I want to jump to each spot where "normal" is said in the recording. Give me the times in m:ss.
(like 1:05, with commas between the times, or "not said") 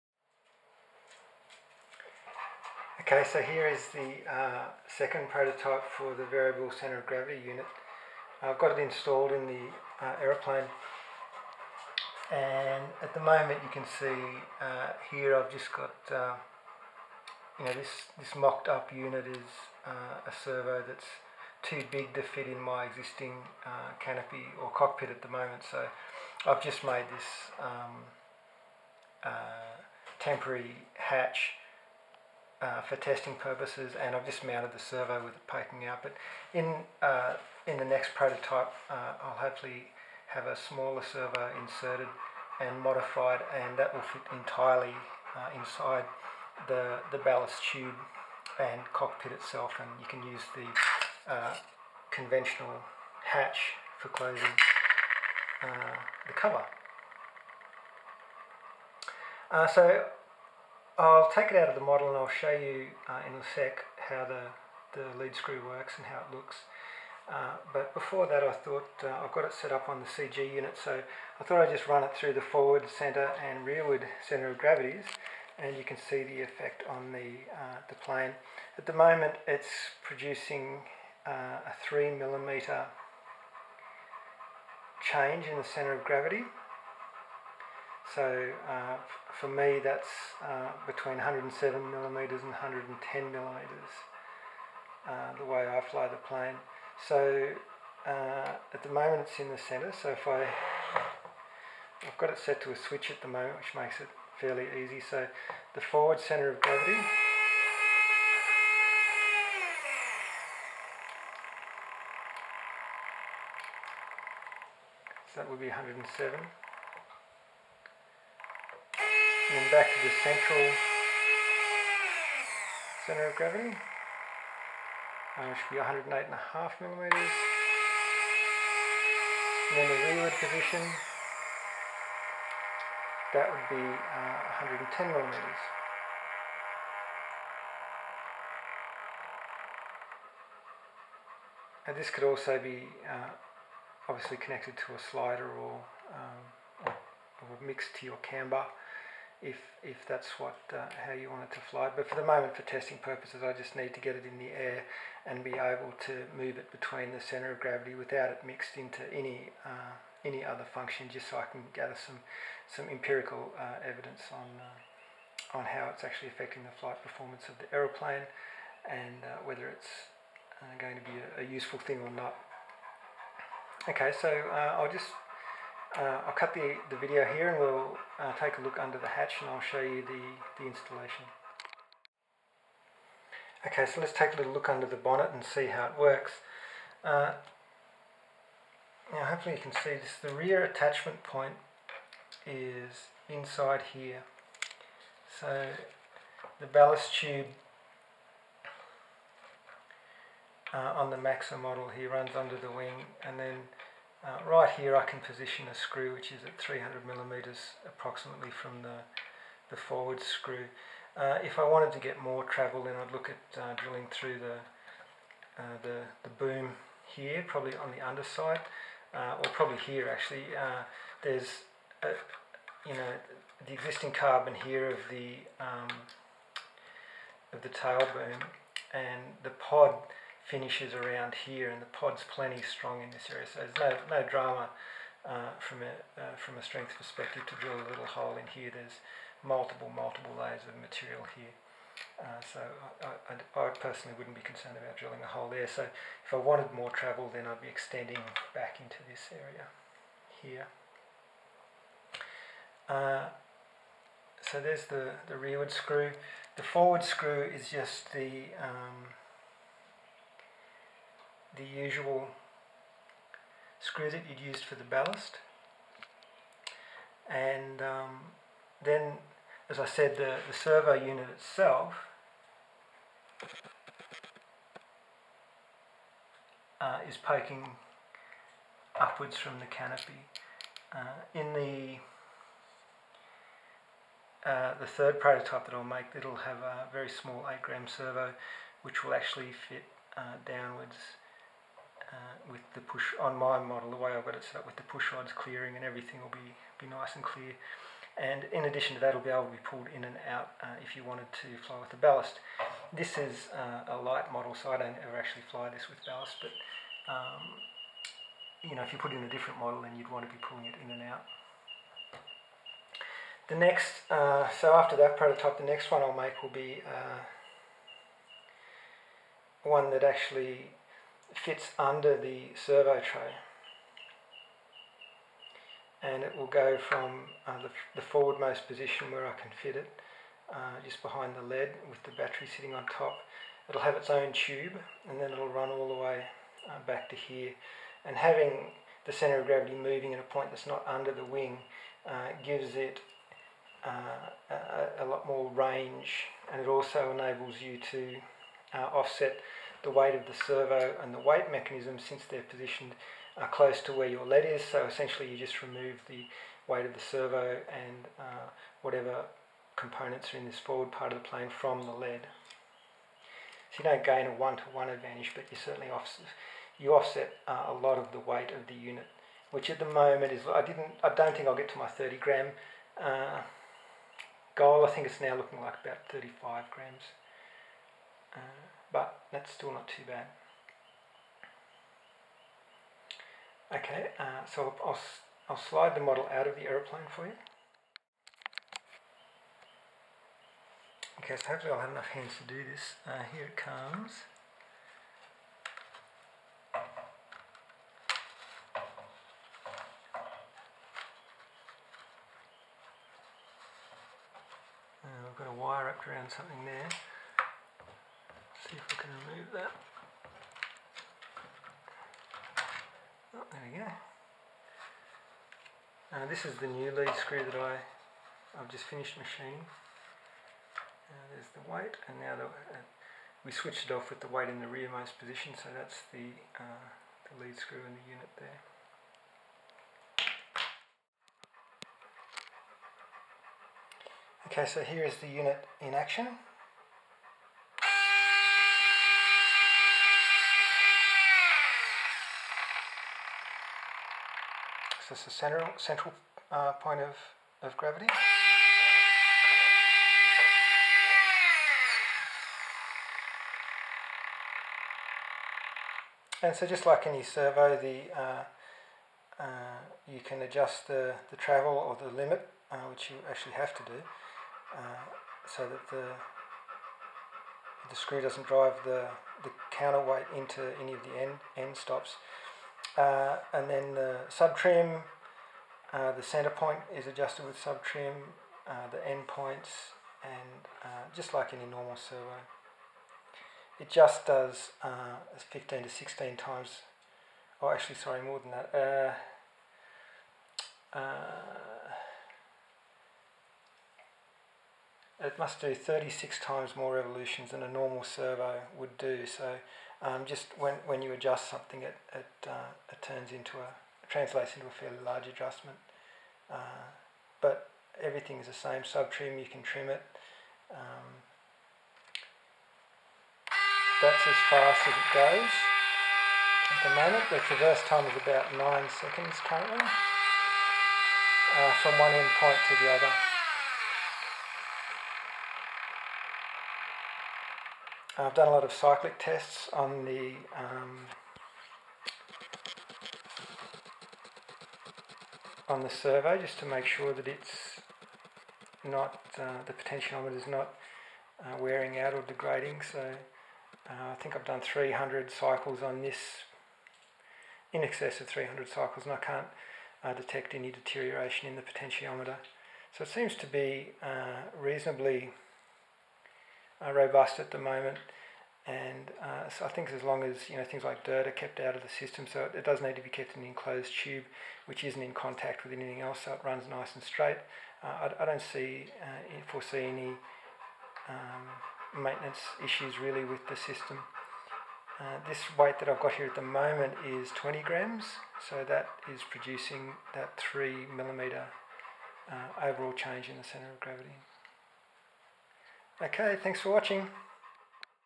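8:01, 8:17.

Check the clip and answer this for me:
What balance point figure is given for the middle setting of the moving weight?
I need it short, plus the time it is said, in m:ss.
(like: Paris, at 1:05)
108.5 millimeters, at 2:05.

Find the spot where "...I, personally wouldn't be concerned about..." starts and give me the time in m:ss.
4:03.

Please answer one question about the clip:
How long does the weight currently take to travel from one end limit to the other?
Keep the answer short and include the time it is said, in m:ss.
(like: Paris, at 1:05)
9 seconds, at 8:38.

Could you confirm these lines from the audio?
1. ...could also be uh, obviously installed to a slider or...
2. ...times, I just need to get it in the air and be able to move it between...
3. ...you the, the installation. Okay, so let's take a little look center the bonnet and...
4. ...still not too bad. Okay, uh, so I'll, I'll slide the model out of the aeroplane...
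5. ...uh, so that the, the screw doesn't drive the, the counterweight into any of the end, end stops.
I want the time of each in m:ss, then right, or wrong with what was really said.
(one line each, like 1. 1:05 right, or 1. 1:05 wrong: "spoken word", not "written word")
1. 2:22 wrong: "connected", not "installed"
2. 2:33 wrong: "purposes", not "times"
3. 2:59 wrong: "under", not "center"
4. 6:19 right
5. 7:44 right.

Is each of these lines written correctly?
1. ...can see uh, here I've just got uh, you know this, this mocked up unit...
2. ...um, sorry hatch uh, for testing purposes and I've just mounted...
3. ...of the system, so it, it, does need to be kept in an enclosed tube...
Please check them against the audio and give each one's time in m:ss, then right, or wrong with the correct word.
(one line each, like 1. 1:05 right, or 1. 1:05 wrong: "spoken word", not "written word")
1. 0:13 right
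2. 0:27 wrong: "temporary", not "sorry"
3. 9:21 right.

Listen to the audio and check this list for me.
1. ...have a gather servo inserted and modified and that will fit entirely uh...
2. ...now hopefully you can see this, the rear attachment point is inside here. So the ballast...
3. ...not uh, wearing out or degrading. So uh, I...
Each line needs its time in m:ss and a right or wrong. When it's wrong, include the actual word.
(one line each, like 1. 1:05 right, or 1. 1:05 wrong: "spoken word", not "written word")
1. 0:40 wrong: "smaller", not "gather"
2. 3:09 right
3. 9:00 right.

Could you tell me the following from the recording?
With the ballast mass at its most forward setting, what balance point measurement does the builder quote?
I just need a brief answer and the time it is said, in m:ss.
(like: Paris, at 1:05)
107, at 1:55.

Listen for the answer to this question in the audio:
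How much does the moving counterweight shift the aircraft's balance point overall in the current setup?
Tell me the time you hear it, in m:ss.
1:21.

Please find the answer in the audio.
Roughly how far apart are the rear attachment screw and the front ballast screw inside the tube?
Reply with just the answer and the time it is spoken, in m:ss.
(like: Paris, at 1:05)
300 millimeters, at 3:26.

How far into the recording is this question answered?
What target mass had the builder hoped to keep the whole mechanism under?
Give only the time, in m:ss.
6:11.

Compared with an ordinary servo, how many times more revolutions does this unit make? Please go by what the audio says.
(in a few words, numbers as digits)
36.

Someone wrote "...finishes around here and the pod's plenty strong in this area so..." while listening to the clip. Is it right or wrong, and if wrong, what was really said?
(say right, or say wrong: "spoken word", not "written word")
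right.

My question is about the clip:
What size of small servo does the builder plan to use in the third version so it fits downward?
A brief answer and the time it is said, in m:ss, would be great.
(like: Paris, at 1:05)
8 gram, at 4:47.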